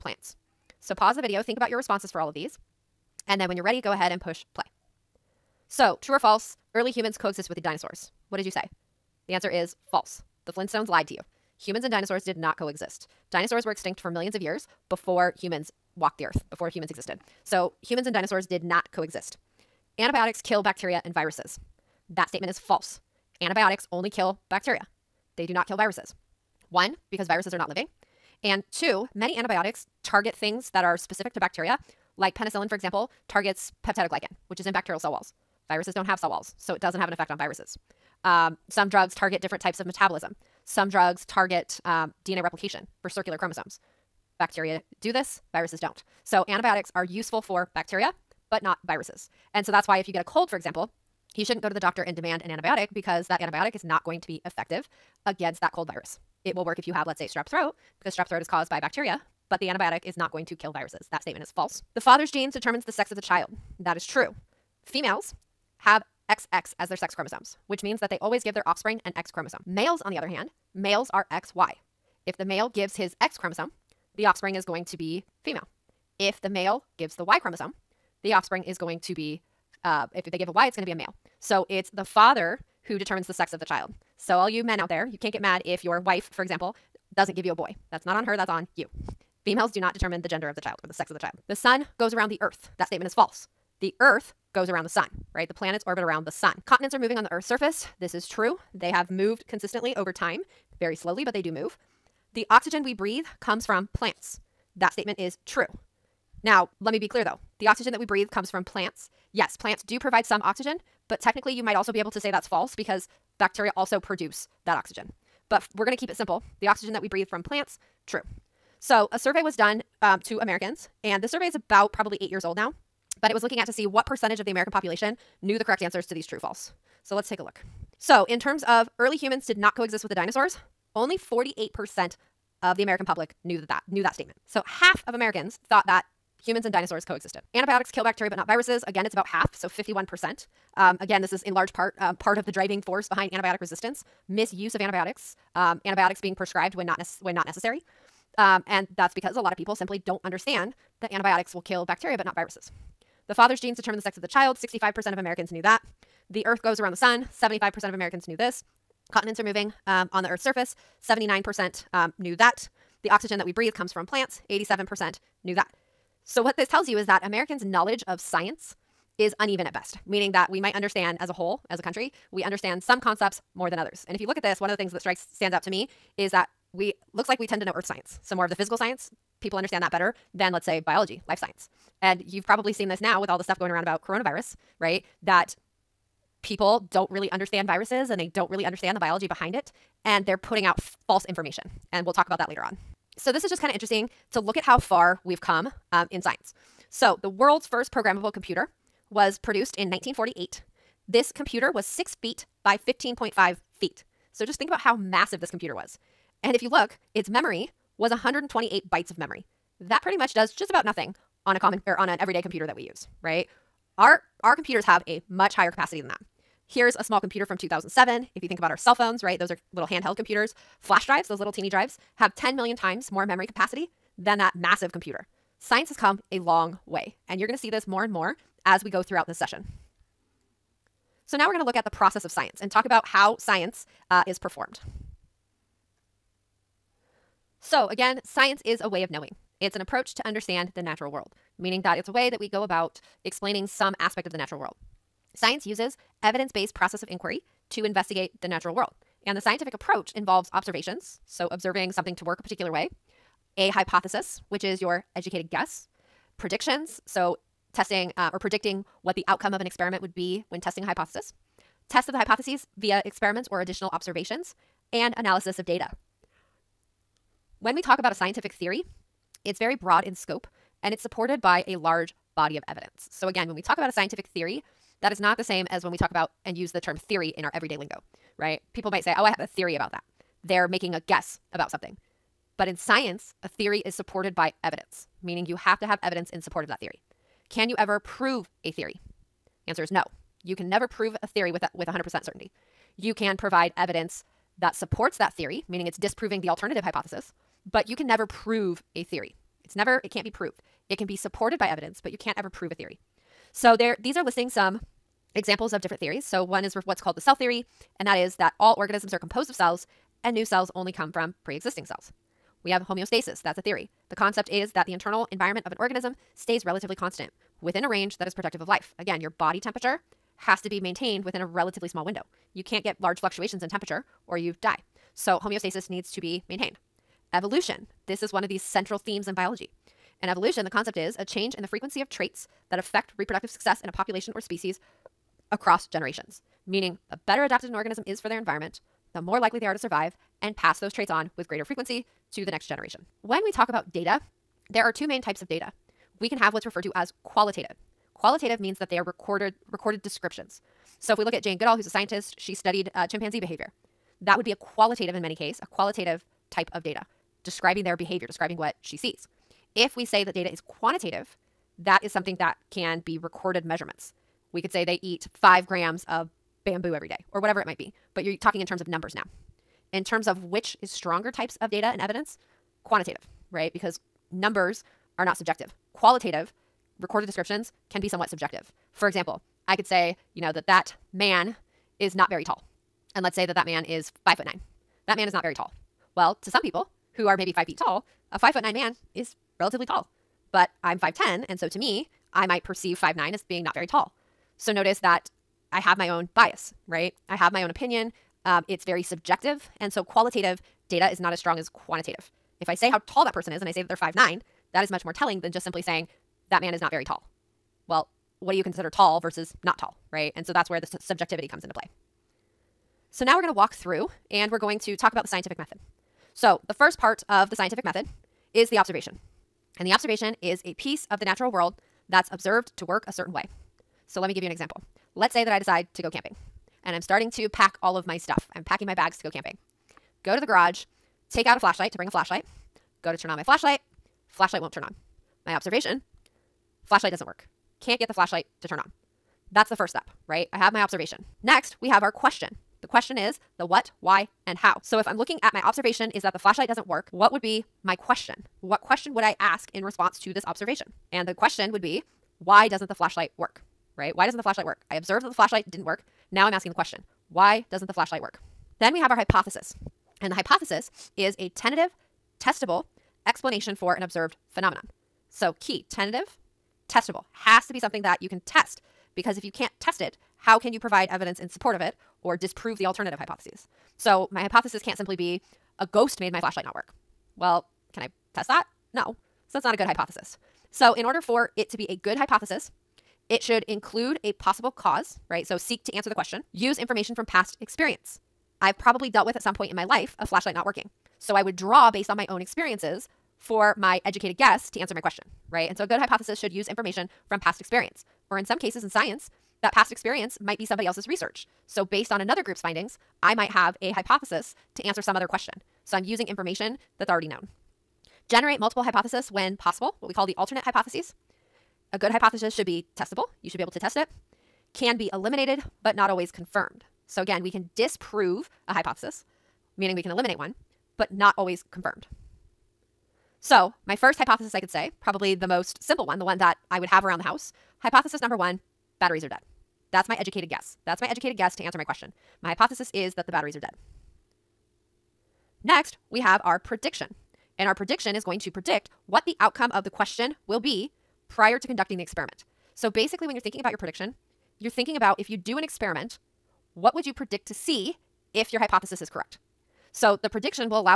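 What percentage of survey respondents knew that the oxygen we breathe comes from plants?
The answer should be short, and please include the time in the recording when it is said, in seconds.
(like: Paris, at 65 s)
87%, at 164 s.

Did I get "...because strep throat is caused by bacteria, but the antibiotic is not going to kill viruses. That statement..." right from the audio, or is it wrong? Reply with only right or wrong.
right.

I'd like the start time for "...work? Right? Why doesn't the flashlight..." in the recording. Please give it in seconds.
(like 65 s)
453 s.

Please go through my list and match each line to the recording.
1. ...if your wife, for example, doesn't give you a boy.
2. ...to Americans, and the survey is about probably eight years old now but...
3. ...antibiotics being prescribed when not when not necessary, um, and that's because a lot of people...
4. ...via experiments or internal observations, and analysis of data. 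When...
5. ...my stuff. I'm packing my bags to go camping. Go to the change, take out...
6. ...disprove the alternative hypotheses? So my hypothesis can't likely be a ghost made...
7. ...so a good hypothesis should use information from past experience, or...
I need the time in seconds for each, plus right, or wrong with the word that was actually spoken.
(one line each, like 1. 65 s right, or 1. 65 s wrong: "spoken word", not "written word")
1. 85 s right
2. 120 s right
3. 145 s right
4. 262 s wrong: "additional", not "internal"
5. 428 s wrong: "garage", not "change"
6. 472 s wrong: "simply", not "likely"
7. 495 s right.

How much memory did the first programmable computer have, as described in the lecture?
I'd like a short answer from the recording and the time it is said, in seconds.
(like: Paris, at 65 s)
128 bytes, at 208 s.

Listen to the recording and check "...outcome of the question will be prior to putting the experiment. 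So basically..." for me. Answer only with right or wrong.
wrong.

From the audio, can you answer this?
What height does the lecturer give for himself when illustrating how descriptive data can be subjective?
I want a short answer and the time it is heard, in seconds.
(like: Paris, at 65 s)
5'10, at 390 s.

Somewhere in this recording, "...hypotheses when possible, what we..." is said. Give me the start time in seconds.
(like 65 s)
508 s.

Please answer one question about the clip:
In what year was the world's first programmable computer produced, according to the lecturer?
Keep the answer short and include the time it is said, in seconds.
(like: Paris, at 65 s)
1948, at 199 s.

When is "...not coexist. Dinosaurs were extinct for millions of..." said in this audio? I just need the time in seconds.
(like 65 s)
12 s.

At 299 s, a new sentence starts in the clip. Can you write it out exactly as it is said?
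It's never, it can't be proved.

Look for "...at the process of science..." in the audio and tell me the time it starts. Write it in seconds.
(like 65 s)
231 s.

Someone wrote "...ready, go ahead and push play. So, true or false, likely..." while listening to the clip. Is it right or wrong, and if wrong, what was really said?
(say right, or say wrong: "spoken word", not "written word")
wrong: "early", not "likely".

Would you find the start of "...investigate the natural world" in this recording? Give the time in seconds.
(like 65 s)
247 s.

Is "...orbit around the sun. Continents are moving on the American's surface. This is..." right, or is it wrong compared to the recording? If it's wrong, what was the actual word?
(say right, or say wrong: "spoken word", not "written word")
wrong: "Earth", not "American".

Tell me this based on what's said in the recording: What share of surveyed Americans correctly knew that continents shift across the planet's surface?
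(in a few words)
79%.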